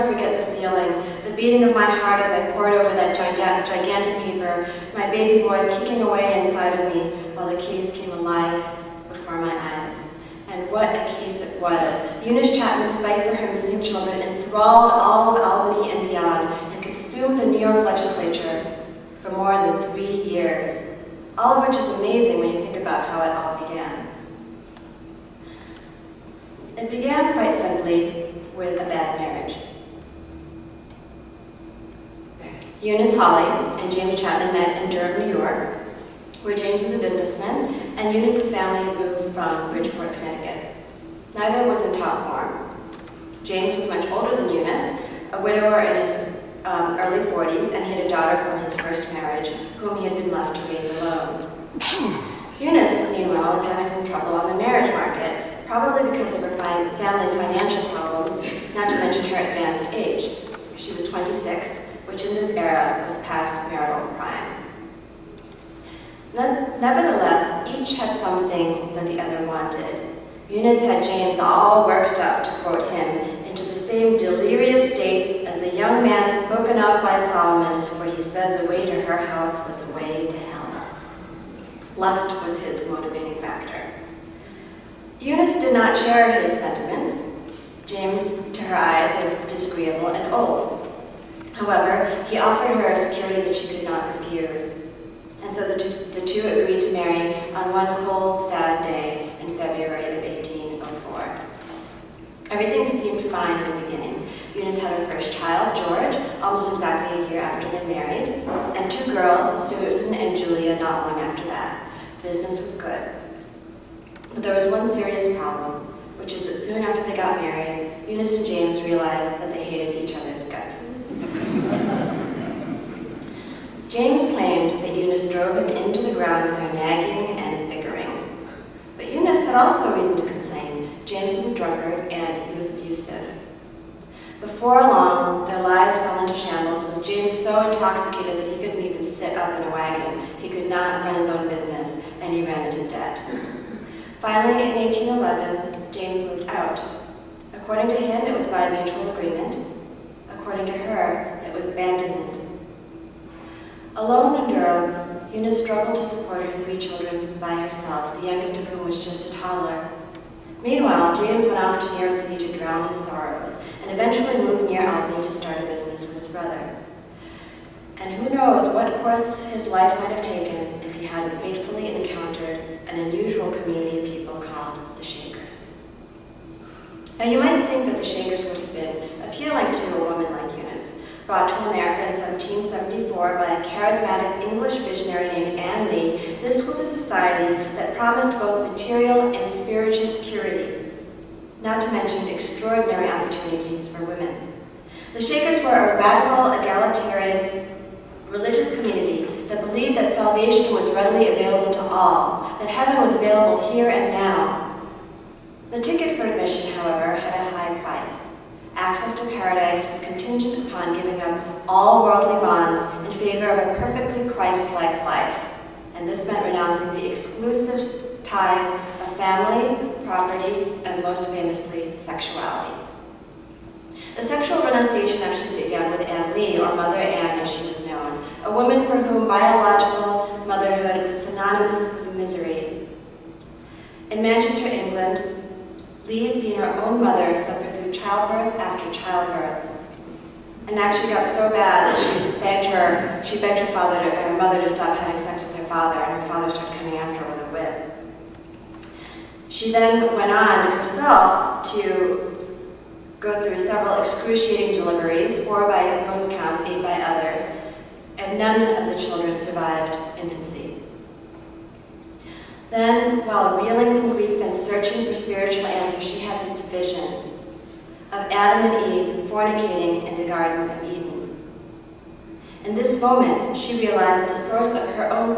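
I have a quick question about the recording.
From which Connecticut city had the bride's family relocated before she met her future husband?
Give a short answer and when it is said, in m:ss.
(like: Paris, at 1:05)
Bridgeport, at 0:39.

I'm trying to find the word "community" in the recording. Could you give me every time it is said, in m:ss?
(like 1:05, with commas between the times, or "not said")
2:53, 3:18.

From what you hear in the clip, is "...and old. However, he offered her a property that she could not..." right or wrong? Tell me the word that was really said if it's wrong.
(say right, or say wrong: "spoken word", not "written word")
wrong: "security", not "property".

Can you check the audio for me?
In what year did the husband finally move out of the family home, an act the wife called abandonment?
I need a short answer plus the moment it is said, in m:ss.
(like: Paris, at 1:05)
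1811, at 2:24.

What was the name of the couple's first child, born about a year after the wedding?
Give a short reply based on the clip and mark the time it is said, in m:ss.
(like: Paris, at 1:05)
George, at 1:45.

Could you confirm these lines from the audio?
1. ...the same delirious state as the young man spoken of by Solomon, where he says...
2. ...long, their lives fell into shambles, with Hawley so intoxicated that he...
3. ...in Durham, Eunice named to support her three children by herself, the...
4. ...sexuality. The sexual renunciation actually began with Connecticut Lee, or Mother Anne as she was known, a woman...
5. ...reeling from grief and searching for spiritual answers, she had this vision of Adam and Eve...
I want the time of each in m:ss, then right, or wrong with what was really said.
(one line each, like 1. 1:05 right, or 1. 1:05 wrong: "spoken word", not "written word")
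1. 1:13 right
2. 2:14 wrong: "James", not "Hawley"
3. 2:34 wrong: "struggled", not "named"
4. 3:41 wrong: "Anne", not "Connecticut"
5. 4:23 right.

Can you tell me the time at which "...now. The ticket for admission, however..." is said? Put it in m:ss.
3:24.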